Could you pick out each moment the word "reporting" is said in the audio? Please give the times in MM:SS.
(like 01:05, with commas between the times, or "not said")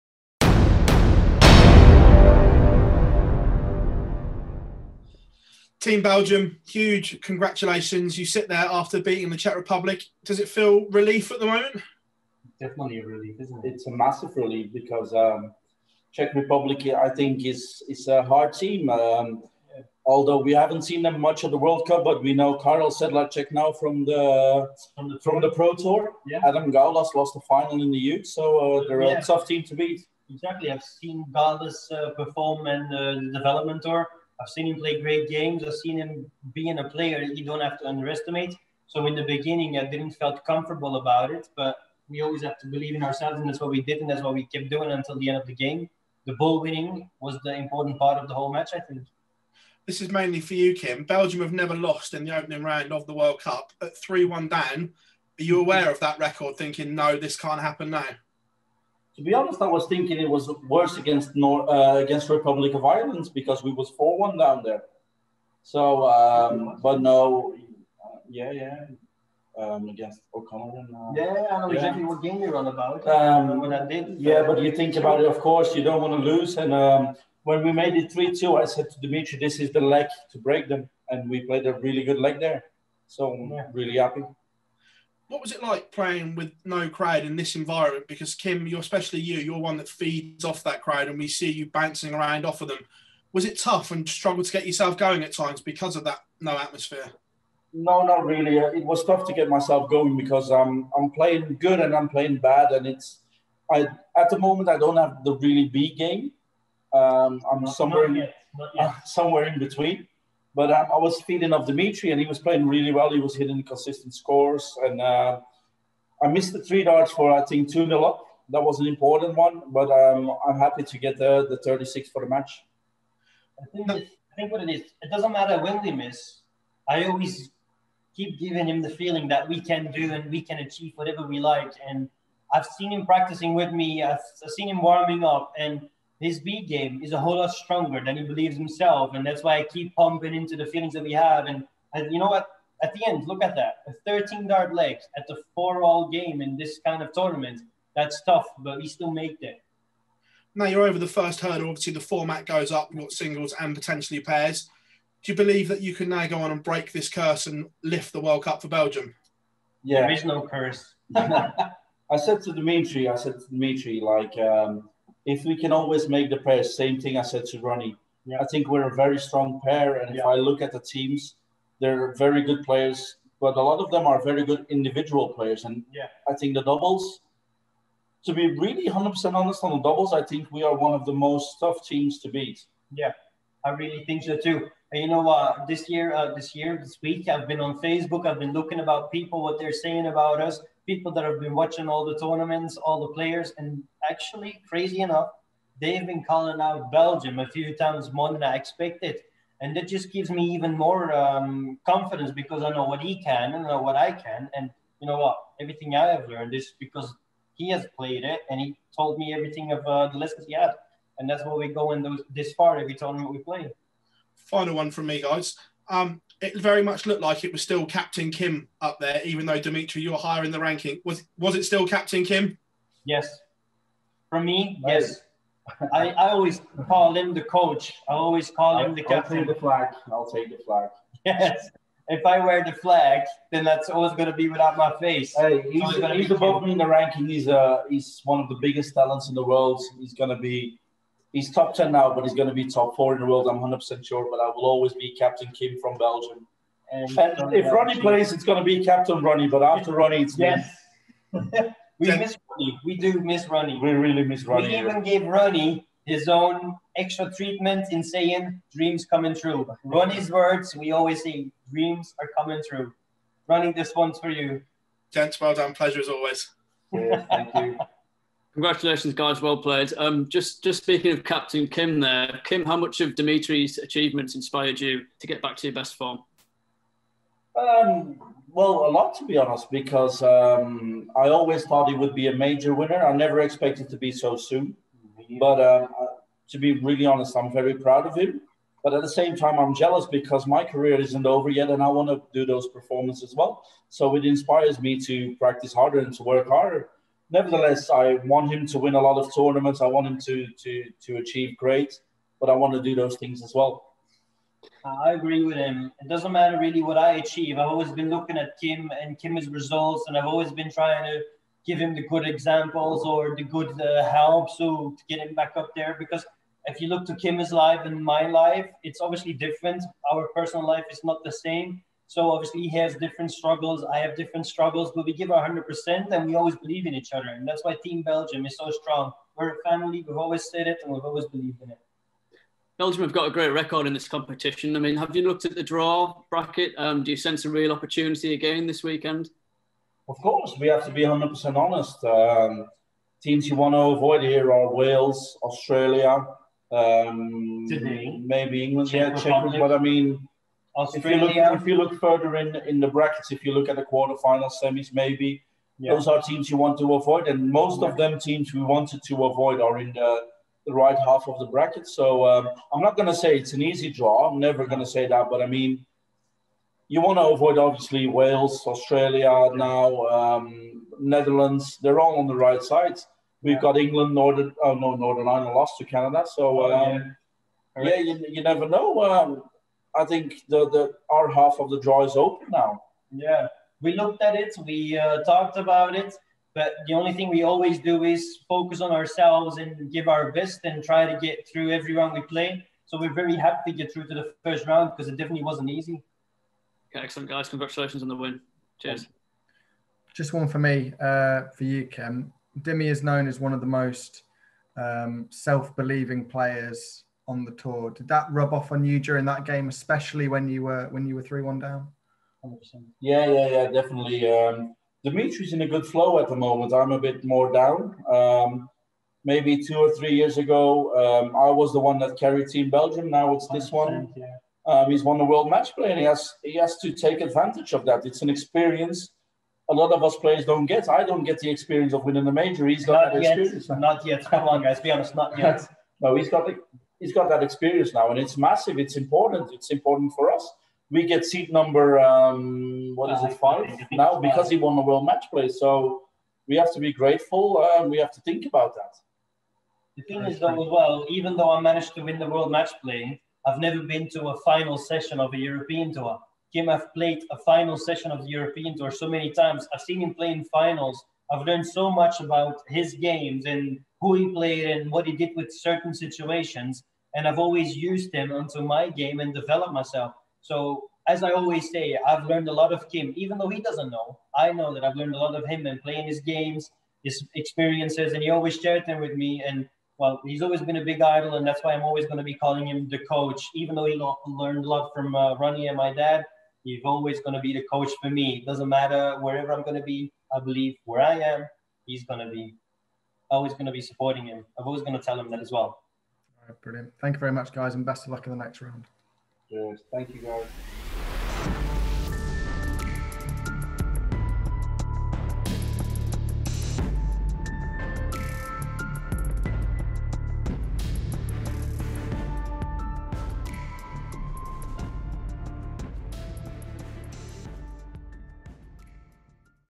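not said.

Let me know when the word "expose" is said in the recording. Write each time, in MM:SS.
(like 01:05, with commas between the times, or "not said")
not said.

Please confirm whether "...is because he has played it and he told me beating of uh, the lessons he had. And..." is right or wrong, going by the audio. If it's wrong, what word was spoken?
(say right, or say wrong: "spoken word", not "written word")
wrong: "everything", not "beating".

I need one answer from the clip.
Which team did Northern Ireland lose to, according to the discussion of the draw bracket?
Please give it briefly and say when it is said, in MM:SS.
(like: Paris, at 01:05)
Canada, at 06:15.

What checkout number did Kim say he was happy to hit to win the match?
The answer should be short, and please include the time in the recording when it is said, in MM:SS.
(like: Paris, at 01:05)
36, at 02:01.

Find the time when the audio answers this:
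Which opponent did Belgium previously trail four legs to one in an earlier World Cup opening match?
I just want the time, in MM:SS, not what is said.
01:02.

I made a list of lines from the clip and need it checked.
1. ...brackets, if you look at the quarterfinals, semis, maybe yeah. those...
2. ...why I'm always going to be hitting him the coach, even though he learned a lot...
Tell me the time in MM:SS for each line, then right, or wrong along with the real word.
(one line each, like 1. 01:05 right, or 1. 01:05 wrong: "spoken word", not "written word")
1. 05:52 right
2. 08:01 wrong: "calling", not "hitting".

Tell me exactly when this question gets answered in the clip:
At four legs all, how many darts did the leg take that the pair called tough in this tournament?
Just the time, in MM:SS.
02:24.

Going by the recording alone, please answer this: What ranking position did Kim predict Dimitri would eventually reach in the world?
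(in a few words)
top 4.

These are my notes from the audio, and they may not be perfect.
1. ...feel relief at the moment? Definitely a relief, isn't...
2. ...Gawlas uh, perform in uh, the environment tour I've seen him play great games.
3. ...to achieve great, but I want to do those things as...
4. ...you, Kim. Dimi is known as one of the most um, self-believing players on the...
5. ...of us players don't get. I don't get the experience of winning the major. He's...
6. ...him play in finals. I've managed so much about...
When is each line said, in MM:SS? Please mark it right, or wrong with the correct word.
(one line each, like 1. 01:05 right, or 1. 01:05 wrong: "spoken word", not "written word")
1. 00:10 right
2. 00:31 wrong: "development", not "environment"
3. 05:01 right
4. 06:41 right
5. 07:09 right
6. 07:40 wrong: "learned", not "managed".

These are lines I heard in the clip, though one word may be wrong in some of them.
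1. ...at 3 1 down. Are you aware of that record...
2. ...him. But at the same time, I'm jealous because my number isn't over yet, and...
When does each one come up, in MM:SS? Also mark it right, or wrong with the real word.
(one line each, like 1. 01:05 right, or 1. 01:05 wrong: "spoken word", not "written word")
1. 00:53 right
2. 04:48 wrong: "career", not "number".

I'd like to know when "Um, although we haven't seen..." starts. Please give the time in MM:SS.
00:18.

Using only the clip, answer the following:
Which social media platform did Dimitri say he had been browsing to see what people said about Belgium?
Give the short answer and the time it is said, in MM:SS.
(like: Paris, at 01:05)
Facebook, at 03:07.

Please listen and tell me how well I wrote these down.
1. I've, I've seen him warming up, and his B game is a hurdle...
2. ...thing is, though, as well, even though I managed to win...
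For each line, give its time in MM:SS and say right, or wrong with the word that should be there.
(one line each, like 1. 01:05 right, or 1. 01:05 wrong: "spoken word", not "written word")
1. 02:14 wrong: "whole", not "hurdle"
2. 07:30 right.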